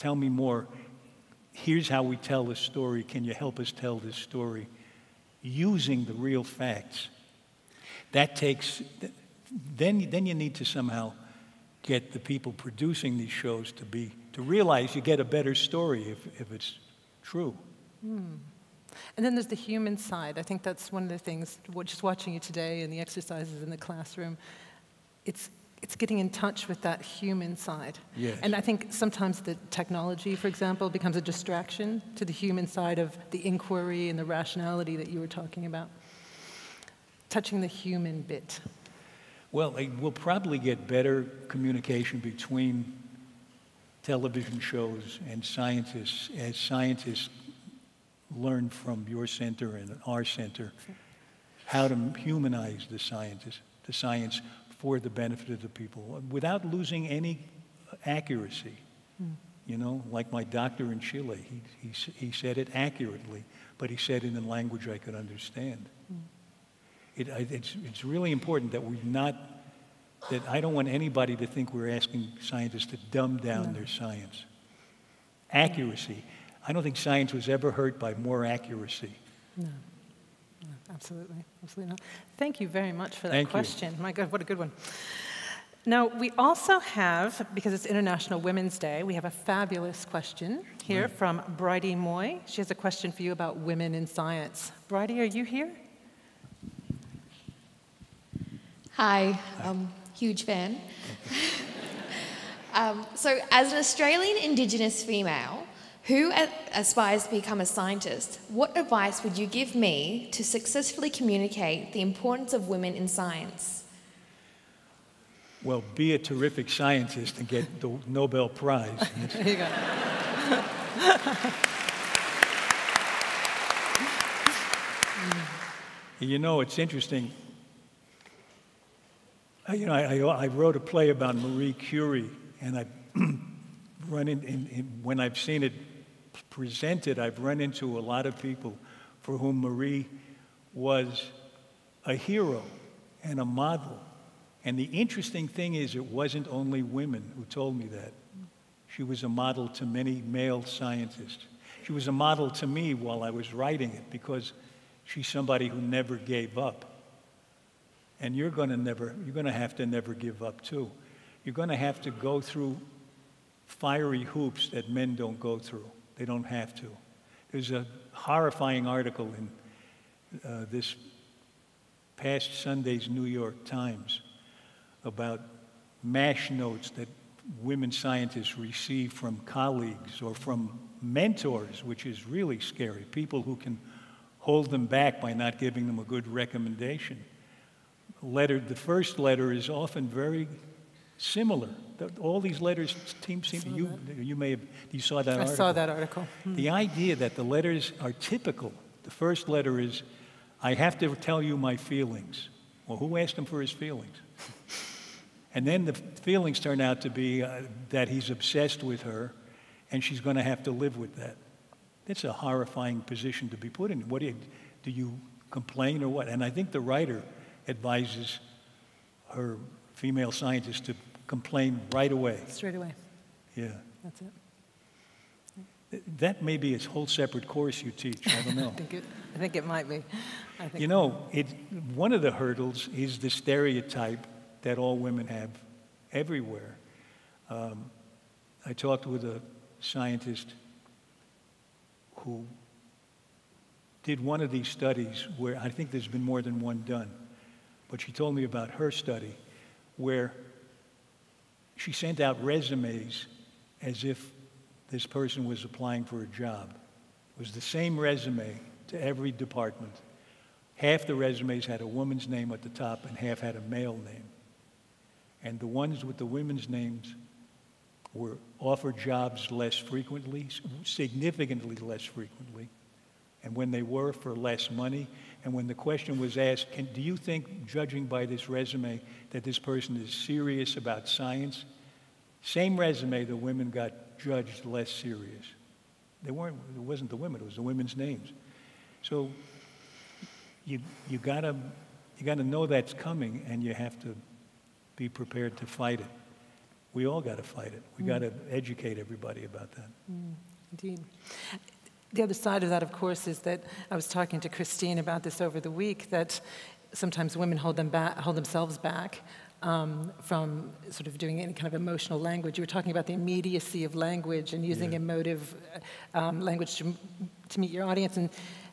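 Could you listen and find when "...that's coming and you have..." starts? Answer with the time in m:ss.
4:52.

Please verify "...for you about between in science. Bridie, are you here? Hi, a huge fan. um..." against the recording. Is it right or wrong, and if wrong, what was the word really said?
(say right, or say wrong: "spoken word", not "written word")
wrong: "women", not "between".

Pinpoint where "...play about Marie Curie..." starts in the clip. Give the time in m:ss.
2:10.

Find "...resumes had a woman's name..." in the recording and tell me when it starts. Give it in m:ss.
4:21.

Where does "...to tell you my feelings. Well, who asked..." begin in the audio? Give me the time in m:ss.
3:20.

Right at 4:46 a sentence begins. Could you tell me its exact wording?
They weren't, it wasn't the women, it was the women's names.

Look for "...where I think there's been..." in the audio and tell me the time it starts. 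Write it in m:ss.
4:05.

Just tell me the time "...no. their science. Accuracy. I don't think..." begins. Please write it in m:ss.
1:13.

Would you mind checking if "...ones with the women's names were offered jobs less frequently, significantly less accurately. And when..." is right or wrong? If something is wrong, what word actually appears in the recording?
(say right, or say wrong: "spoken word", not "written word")
wrong: "frequently", not "accurately".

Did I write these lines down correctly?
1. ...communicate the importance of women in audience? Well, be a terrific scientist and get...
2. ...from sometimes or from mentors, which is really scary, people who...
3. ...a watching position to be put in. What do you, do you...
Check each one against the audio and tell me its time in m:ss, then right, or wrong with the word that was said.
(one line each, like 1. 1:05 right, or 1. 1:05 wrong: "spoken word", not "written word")
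1. 1:51 wrong: "science", not "audience"
2. 2:59 wrong: "colleagues", not "sometimes"
3. 3:32 wrong: "horrifying", not "watching".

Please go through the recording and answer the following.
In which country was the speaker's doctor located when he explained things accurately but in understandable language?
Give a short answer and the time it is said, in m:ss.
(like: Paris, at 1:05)
Chile, at 1:00.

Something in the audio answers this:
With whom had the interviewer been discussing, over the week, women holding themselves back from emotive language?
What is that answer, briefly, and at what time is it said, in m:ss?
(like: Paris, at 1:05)
Christine, at 5:04.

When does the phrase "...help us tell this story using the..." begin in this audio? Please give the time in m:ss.
0:03.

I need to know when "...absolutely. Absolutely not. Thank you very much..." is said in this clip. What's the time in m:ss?
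1:20.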